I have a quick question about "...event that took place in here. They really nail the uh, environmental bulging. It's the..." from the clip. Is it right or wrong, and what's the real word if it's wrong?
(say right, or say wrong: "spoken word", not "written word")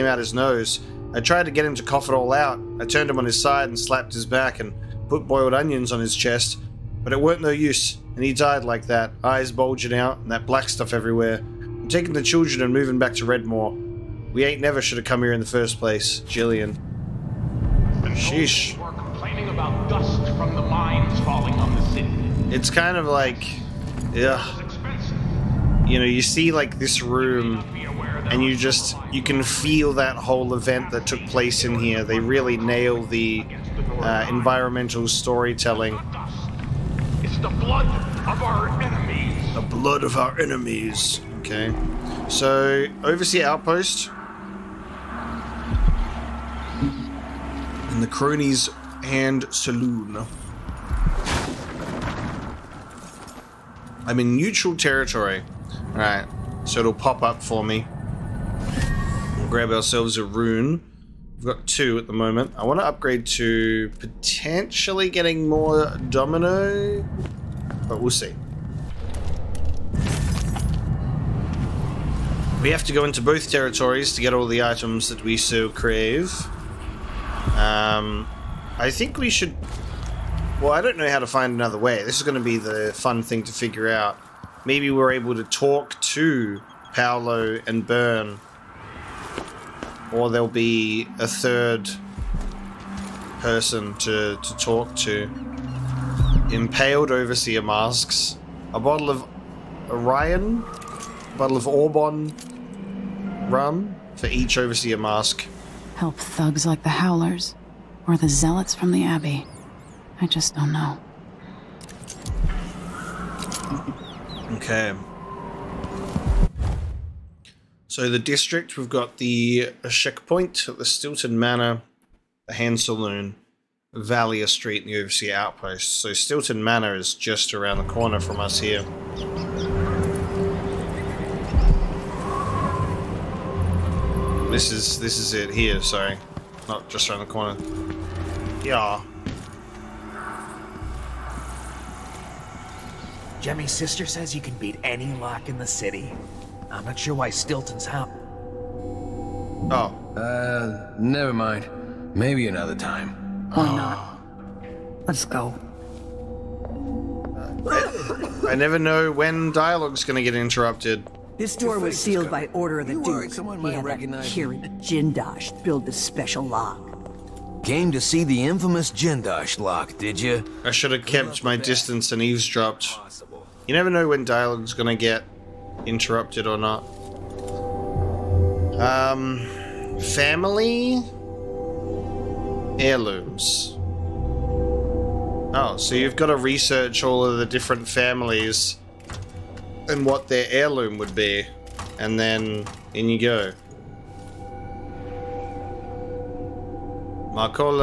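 wrong: "storytelling", not "bulging".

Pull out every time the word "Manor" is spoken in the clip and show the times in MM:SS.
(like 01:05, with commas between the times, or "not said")
02:01, 02:06.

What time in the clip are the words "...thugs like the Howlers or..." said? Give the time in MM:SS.
01:46.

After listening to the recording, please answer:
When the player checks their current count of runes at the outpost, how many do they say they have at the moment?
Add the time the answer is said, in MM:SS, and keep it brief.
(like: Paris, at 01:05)
2, at 01:01.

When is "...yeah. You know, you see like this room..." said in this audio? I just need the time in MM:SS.
00:24.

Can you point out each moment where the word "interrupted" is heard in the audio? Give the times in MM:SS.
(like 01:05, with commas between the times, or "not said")
02:40, 02:55.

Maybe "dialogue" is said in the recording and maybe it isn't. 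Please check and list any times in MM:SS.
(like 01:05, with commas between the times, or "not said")
02:39, 02:54.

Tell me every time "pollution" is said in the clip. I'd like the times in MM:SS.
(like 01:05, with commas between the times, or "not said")
not said.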